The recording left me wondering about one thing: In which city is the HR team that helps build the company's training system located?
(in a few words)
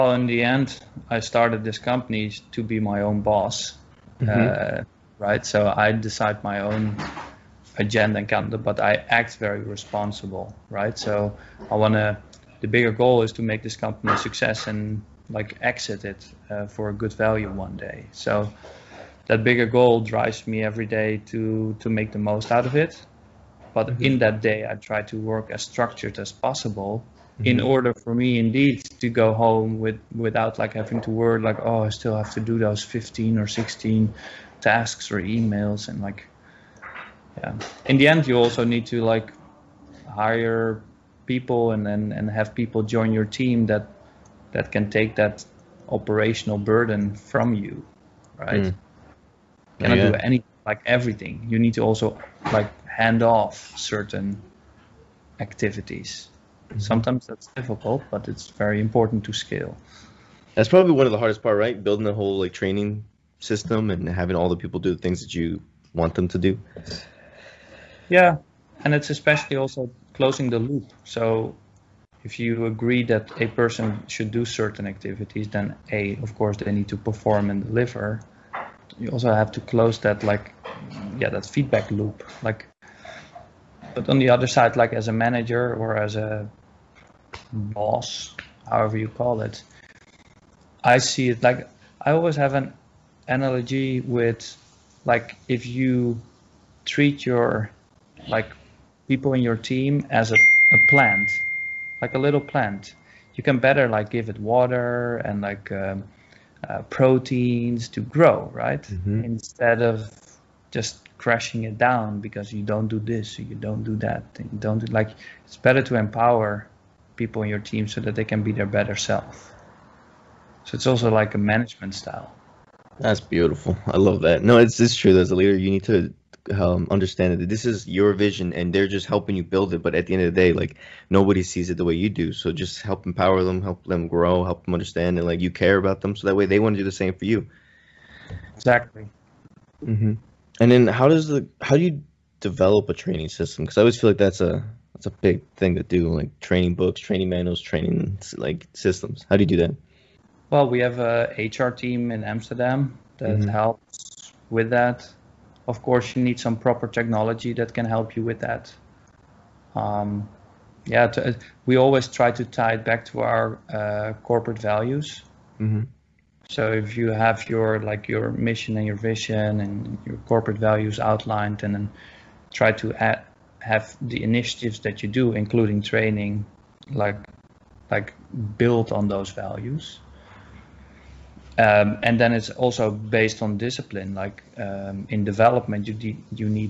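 Amsterdam.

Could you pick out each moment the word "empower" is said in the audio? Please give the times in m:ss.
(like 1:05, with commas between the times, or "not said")
1:55, 2:13.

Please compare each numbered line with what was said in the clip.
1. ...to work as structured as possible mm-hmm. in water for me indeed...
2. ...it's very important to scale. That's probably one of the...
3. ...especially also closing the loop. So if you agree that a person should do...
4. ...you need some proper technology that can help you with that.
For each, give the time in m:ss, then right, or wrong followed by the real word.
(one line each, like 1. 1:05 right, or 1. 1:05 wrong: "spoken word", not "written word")
1. 0:25 wrong: "order", not "water"
2. 0:58 right
3. 1:09 right
4. 2:36 right.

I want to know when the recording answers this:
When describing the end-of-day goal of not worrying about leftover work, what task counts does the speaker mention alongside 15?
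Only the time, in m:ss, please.
0:33.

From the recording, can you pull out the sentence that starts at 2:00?
So it's also like a management style.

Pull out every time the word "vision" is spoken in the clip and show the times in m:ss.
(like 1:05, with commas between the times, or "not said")
2:08, 2:48.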